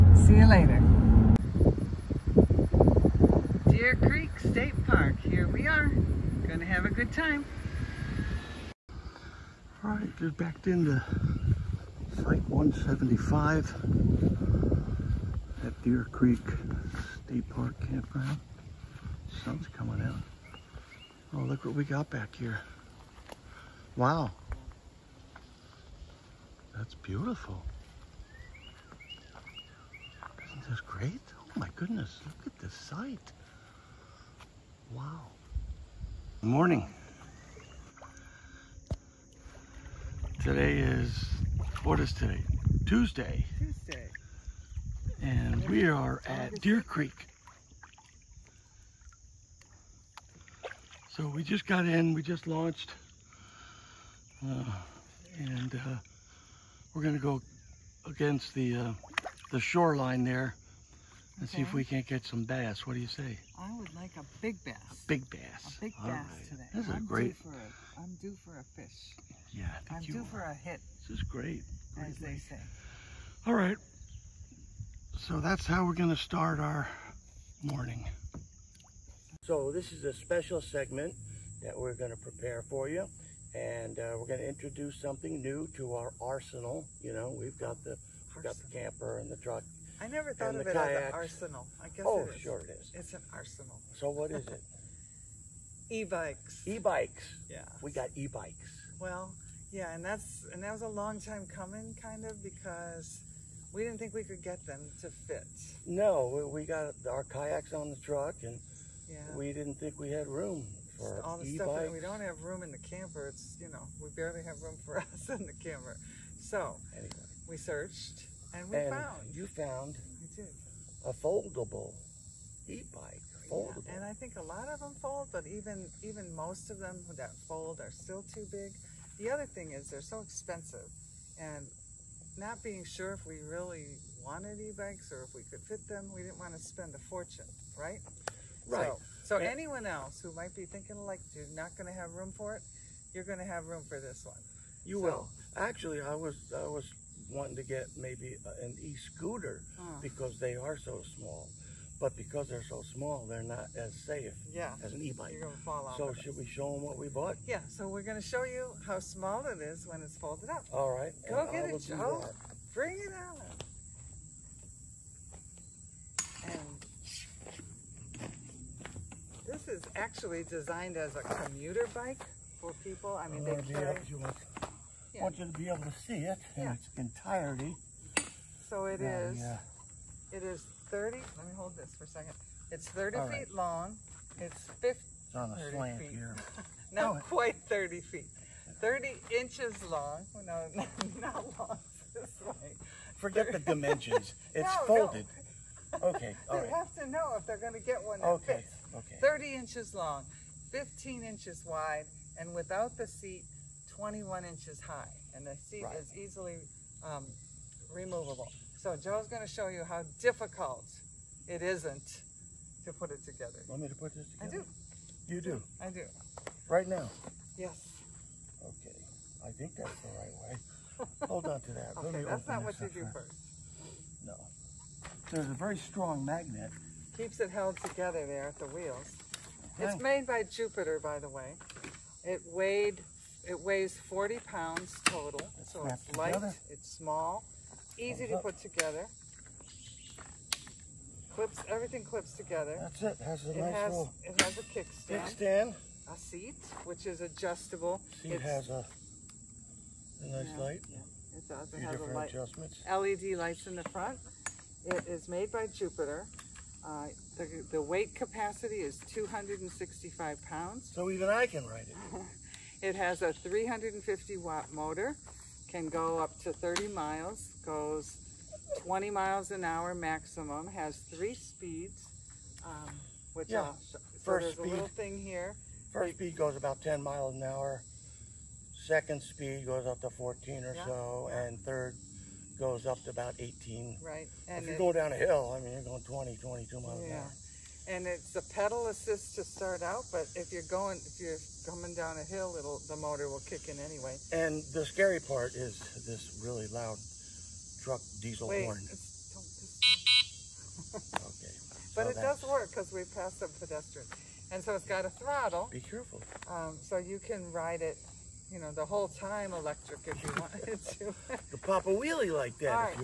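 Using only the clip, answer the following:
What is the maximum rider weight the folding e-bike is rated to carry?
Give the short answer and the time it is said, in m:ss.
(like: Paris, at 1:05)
265 pounds, at 4:19.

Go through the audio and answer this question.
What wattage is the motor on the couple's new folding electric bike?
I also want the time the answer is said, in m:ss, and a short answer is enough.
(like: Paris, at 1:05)
350 watt, at 4:23.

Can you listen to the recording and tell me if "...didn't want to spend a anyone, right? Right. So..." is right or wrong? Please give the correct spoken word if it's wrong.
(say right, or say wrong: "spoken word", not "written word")
wrong: "fortune", not "anyone".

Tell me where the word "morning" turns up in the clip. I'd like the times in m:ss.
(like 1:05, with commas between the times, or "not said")
0:36, 1:17.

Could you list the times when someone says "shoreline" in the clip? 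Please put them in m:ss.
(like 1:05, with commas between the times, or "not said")
0:59.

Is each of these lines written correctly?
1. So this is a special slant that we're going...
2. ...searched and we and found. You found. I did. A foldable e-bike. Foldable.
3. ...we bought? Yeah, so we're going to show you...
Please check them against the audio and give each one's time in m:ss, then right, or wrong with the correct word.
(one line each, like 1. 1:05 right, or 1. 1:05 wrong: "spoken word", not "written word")
1. 1:19 wrong: "segment", not "slant"
2. 1:57 right
3. 2:36 right.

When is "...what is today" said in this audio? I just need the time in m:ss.
0:41.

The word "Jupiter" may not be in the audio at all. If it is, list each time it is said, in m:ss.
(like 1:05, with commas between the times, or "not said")
3:50, 4:15.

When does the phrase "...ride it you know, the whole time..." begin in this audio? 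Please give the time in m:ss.
5:07.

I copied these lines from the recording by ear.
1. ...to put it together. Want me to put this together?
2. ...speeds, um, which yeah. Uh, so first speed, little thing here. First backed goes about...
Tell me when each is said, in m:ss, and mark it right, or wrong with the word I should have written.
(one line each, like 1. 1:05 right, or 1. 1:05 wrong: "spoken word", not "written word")
1. 3:32 right
2. 4:31 wrong: "speed", not "backed".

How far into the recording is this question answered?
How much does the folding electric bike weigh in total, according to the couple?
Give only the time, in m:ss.
3:54.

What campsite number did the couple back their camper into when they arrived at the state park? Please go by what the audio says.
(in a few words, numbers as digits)
175.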